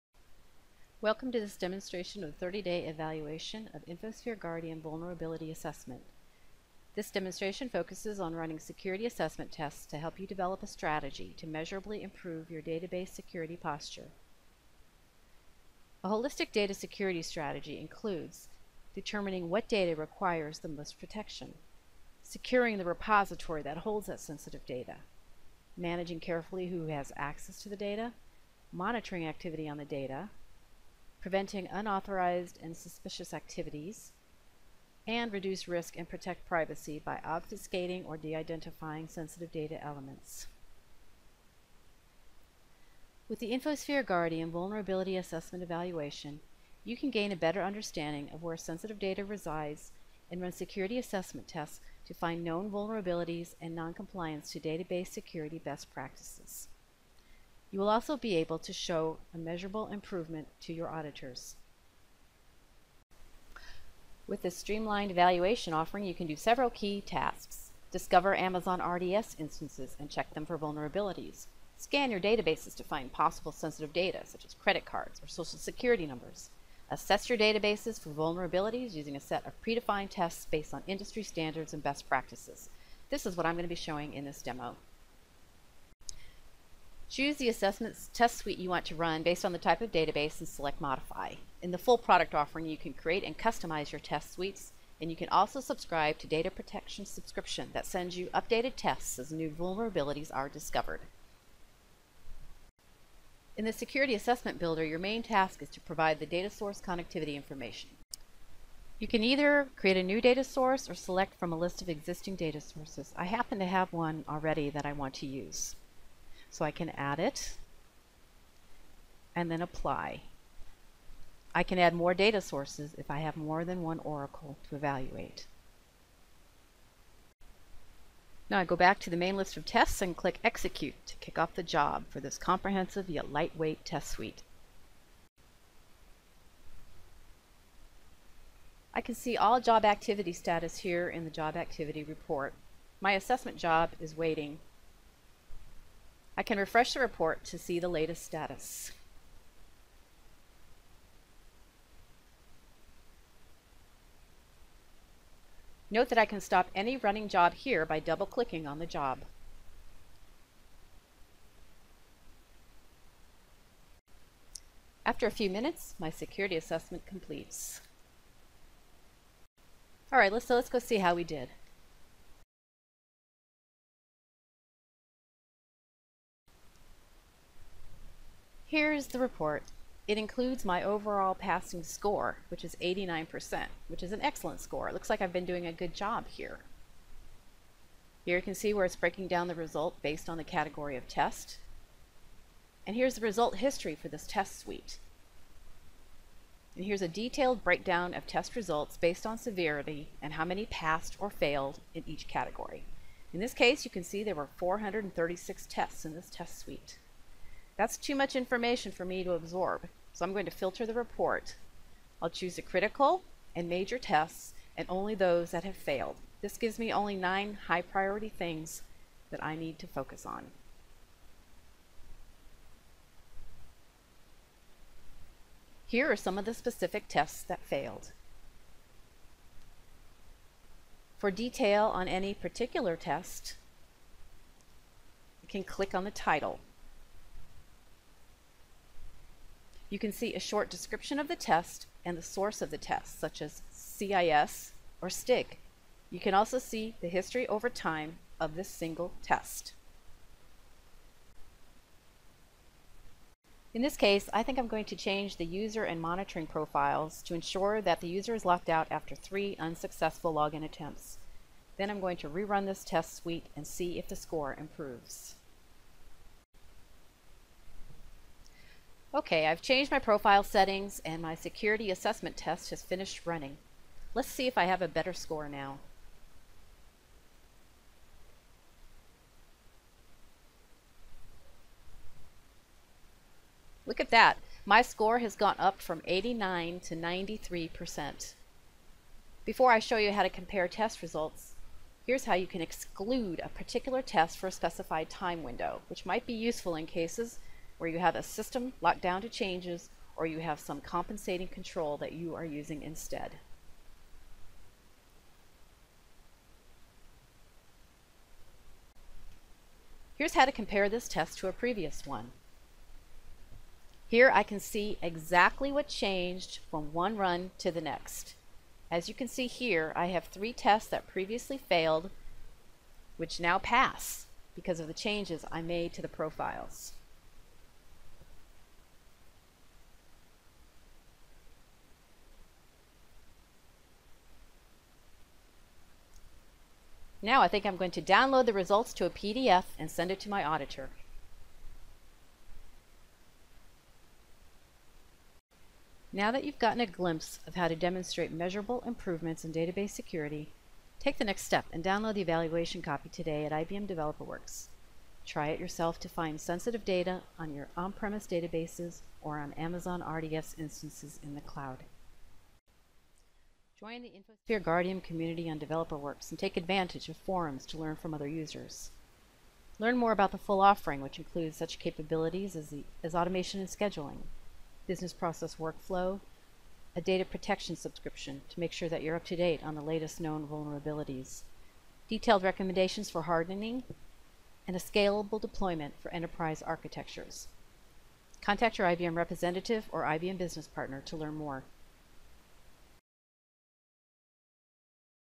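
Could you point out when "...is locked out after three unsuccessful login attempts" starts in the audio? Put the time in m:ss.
4:18.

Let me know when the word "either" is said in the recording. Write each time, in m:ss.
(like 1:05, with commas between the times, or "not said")
1:49.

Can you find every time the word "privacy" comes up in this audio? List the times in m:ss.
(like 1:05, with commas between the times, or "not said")
0:36.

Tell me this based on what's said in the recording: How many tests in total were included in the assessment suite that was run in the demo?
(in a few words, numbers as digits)
436.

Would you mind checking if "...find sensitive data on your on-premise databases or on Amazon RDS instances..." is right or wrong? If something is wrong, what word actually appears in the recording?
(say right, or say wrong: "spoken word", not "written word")
right.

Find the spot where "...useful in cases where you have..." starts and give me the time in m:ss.
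4:56.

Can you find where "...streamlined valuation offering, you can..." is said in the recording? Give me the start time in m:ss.
1:04.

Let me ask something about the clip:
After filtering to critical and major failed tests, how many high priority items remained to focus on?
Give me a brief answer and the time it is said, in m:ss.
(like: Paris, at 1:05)
9, at 3:37.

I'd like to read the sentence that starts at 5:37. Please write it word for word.
Now I think I'm going to download the results to a PDF and send it to my auditor.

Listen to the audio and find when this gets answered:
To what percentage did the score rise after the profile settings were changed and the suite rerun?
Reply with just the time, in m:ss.
4:46.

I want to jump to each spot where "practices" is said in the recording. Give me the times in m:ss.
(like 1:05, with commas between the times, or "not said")
0:55, 1:22.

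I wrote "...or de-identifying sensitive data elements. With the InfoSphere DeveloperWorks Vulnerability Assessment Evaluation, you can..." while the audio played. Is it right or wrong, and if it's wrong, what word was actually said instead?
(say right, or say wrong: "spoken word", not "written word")
wrong: "Guardium", not "DeveloperWorks".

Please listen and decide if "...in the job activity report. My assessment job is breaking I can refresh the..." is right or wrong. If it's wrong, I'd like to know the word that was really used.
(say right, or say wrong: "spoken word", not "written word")
wrong: "waiting", not "breaking".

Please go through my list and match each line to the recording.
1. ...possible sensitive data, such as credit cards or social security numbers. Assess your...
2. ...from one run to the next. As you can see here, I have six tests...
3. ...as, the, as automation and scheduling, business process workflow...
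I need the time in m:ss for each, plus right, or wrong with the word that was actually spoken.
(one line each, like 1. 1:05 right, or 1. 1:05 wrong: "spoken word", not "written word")
1. 1:13 right
2. 5:16 wrong: "three", not "six"
3. 6:12 right.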